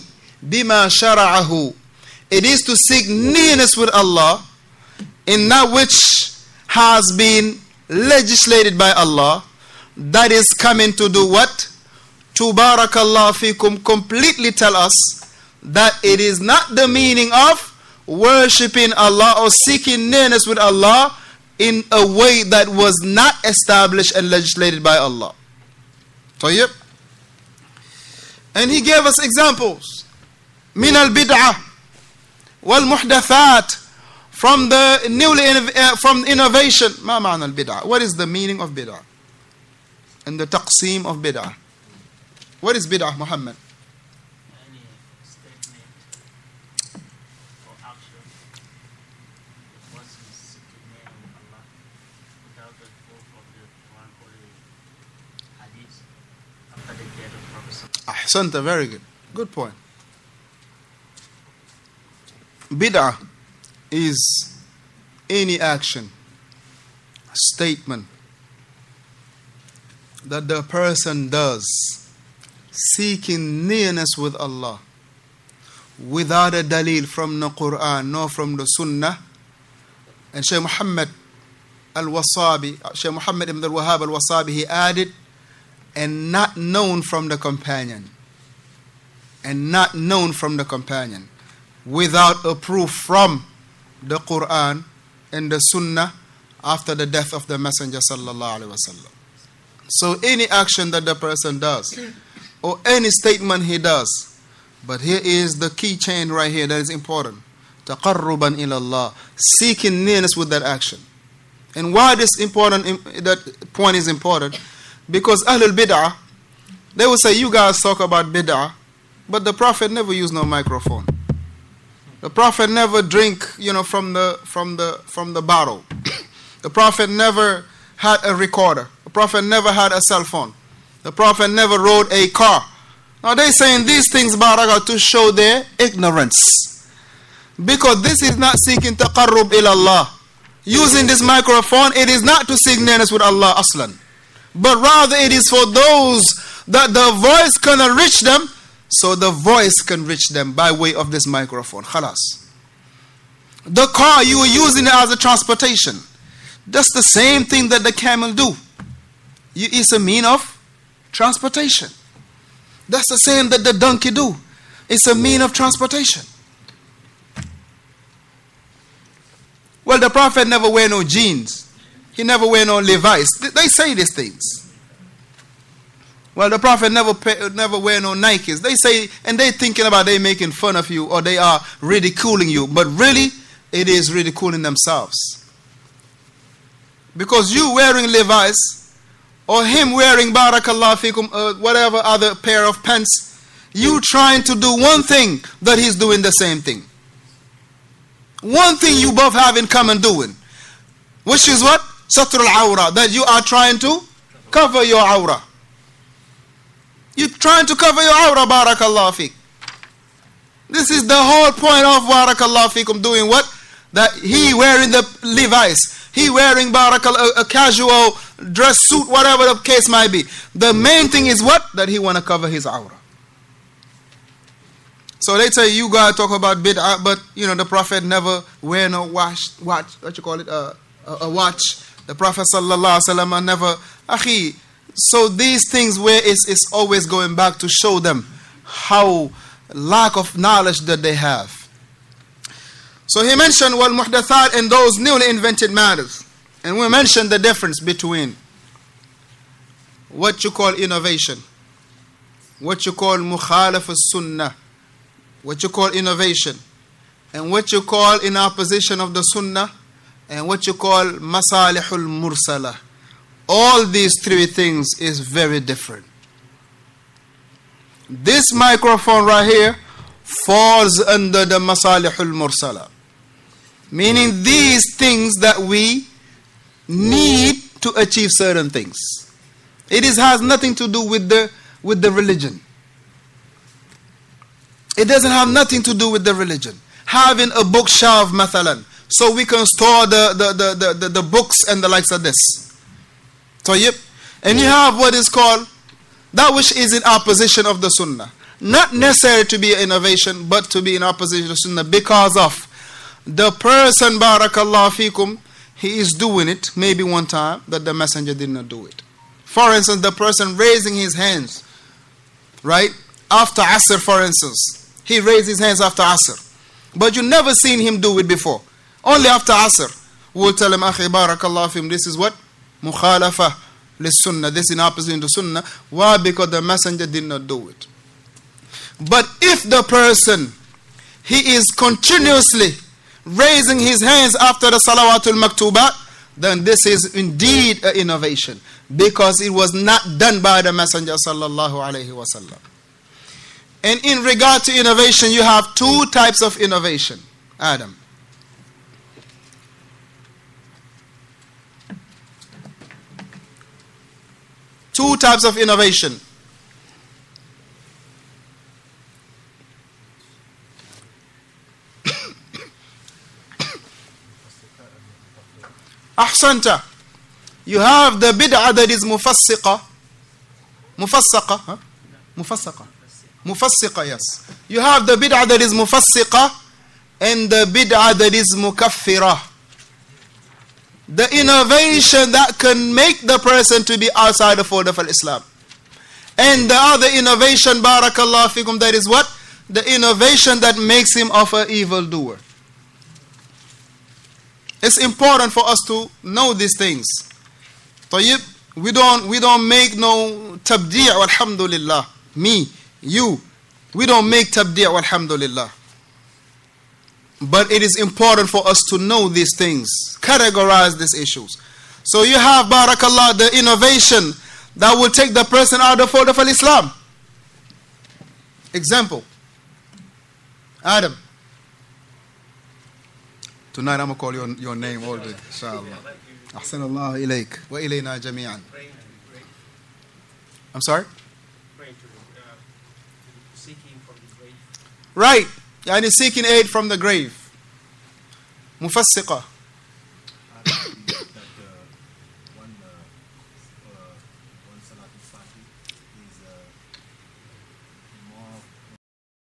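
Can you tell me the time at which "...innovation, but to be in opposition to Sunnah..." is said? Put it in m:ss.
4:59.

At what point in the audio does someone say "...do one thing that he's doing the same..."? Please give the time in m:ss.
3:14.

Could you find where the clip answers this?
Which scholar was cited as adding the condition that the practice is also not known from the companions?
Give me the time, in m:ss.
1:20.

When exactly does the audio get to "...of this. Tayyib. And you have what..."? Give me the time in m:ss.
4:52.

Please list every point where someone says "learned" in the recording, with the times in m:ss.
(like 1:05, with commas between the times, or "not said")
not said.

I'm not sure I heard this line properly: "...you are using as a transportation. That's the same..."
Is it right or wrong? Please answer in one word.
right.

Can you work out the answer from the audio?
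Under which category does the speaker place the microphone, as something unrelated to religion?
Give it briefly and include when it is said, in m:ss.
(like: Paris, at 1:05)
Masalihul Mursala, at 4:31.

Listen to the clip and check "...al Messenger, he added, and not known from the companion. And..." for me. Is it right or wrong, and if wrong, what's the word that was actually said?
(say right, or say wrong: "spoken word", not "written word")
wrong: "Wasabi", not "Messenger".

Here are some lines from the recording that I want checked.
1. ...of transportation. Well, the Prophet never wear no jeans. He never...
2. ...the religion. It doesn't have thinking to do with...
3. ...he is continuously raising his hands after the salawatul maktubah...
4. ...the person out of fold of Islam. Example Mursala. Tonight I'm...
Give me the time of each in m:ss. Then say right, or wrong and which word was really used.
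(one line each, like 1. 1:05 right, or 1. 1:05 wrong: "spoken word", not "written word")
1. 2:45 right
2. 4:42 wrong: "nothing", not "thinking"
3. 5:31 right
4. 6:55 wrong: "Adam", not "Mursala".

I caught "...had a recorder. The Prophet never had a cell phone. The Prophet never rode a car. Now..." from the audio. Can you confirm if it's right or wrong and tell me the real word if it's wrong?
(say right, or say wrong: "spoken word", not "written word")
right.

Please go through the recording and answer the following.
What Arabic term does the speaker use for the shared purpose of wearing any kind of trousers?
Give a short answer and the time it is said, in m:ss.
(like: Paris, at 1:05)
Satrul awra, at 3:22.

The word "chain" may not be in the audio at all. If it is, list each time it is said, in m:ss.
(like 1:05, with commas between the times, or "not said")
1:45.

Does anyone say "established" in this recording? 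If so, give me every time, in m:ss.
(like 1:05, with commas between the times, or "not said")
0:23.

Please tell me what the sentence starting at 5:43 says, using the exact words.
And in regard to innovation, you have two types of innovation, Adam.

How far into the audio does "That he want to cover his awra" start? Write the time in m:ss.
3:41.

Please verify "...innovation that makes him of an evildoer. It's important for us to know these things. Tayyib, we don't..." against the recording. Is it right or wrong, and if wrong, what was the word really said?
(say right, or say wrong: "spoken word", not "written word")
right.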